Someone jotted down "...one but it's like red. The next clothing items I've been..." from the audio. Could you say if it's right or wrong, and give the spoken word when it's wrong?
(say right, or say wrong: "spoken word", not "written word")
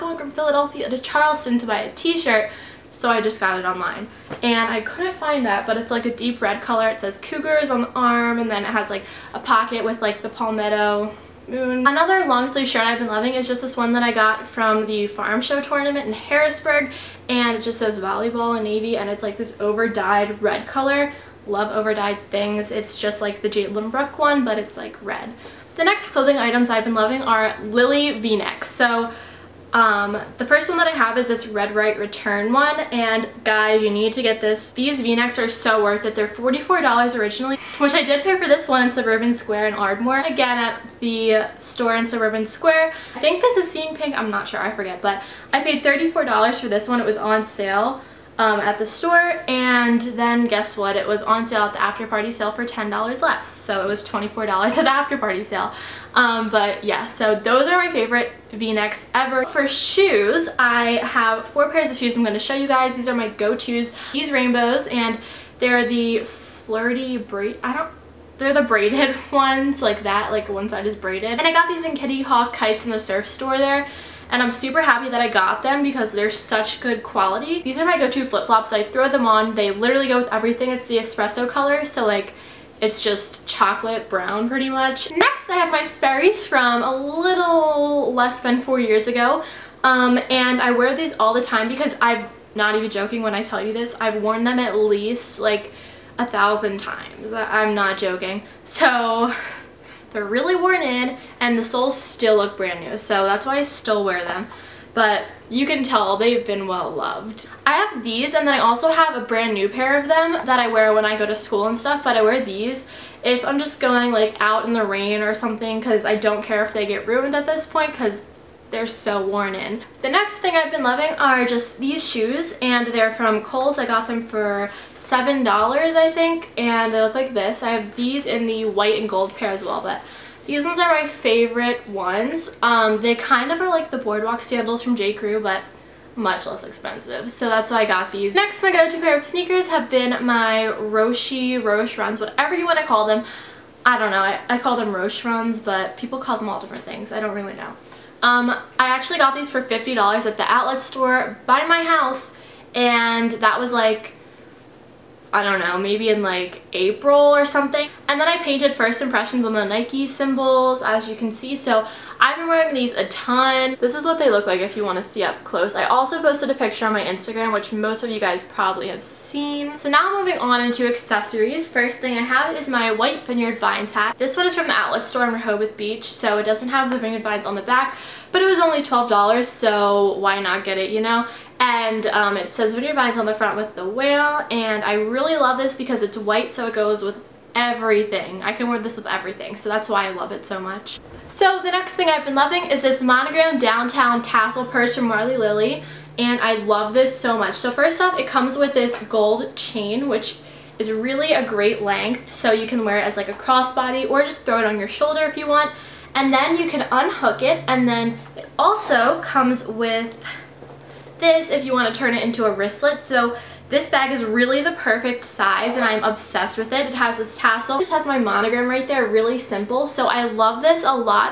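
right.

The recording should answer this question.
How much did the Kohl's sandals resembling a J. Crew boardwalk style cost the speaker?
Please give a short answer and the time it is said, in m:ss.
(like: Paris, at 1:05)
$7, at 2:04.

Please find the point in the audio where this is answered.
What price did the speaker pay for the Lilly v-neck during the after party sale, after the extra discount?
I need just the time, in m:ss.
0:54.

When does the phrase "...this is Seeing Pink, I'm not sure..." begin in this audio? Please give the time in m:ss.
0:43.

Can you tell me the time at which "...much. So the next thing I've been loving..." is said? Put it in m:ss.
3:10.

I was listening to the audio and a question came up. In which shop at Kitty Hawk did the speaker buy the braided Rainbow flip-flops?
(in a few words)
Kitty Hawk Kites.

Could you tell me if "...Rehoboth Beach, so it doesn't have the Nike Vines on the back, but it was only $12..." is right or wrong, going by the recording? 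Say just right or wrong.
wrong.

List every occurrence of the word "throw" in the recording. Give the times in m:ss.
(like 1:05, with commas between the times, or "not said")
1:18, 3:24.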